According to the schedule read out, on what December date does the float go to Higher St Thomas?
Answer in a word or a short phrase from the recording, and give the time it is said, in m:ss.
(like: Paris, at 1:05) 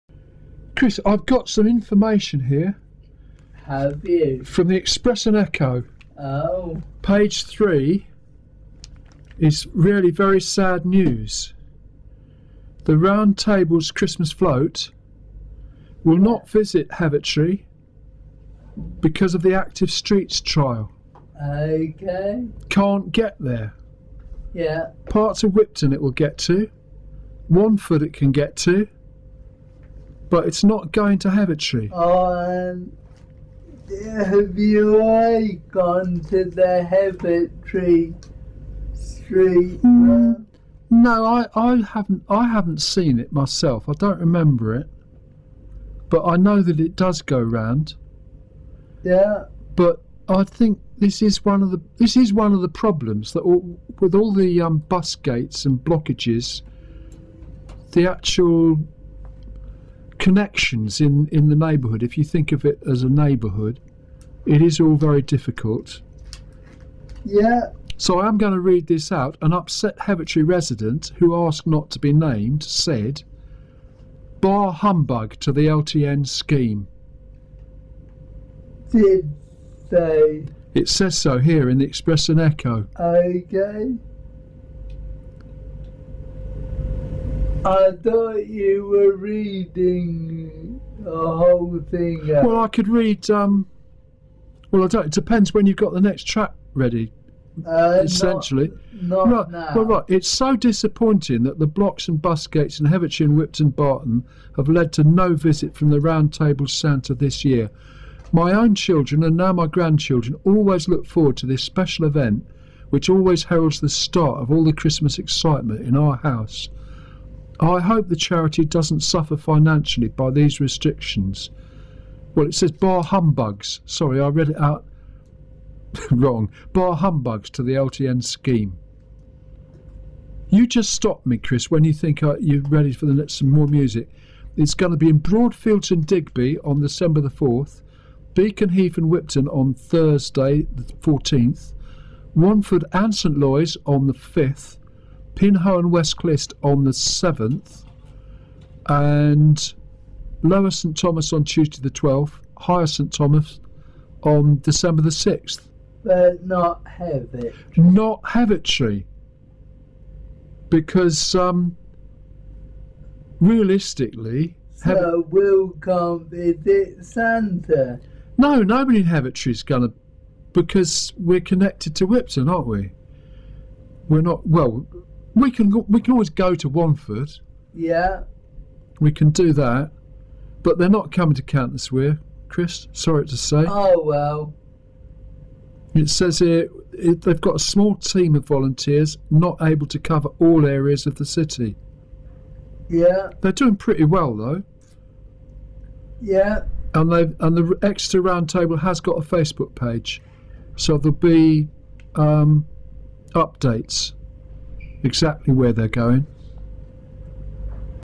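December 6, at 2:34.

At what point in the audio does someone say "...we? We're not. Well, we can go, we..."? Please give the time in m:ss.
2:52.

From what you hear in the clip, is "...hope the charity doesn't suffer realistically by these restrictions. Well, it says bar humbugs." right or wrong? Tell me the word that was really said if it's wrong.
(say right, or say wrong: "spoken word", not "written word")
wrong: "financially", not "realistically".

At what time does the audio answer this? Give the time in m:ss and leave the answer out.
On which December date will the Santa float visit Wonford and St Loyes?
2:24.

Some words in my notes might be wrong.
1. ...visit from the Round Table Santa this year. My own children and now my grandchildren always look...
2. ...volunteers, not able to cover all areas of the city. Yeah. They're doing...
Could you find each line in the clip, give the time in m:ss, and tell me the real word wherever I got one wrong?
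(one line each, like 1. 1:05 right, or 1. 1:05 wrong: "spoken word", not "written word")
1. 1:45 right
2. 3:08 right.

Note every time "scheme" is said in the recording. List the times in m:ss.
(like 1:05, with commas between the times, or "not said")
1:16, 2:08.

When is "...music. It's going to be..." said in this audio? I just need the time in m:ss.
2:13.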